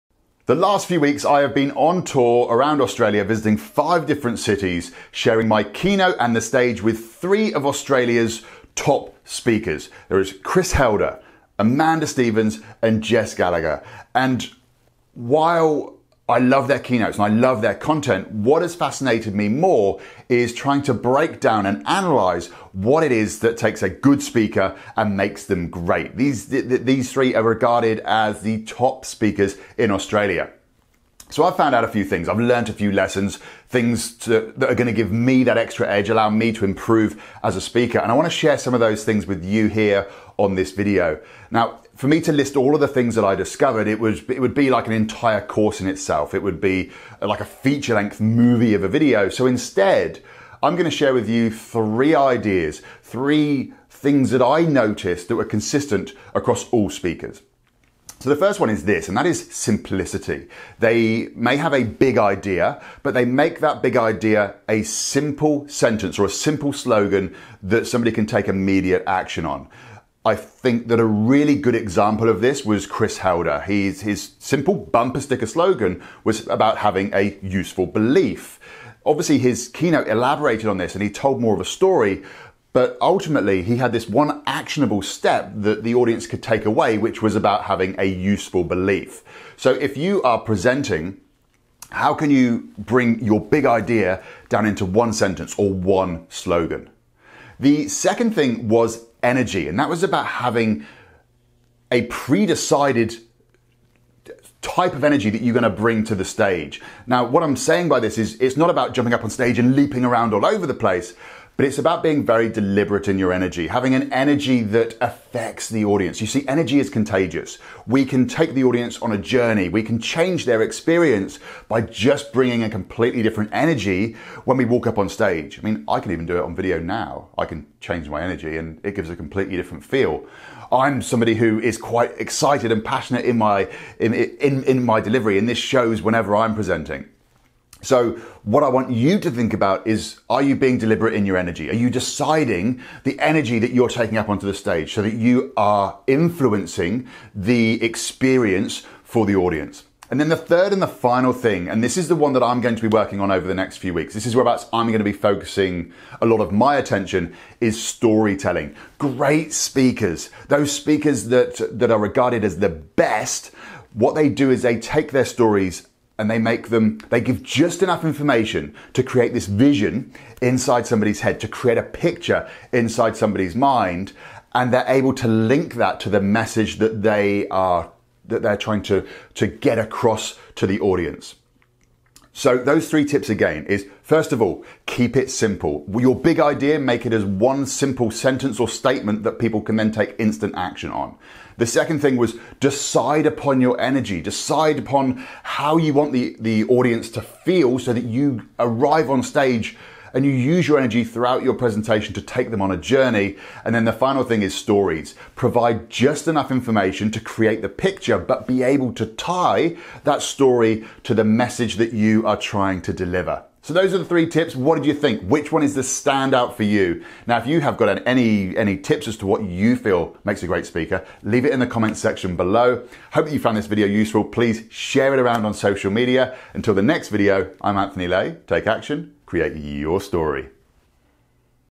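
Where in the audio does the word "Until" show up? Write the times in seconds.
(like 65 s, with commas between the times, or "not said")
226 s.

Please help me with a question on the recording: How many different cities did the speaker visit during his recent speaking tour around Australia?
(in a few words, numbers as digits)
5.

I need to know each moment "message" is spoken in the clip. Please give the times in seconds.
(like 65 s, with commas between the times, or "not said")
176 s, 211 s.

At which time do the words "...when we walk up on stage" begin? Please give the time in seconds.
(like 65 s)
124 s.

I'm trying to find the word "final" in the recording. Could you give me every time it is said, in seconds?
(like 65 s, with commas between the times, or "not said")
150 s, 203 s.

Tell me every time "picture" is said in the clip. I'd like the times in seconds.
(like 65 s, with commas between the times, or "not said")
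171 s, 207 s.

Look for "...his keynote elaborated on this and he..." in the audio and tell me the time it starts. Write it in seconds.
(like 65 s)
79 s.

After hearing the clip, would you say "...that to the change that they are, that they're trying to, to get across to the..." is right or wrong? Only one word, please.
wrong.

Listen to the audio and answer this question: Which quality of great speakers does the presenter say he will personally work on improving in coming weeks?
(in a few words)
Storytelling.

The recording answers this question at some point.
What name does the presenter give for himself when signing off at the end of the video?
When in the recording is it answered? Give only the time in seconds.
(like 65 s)
227 s.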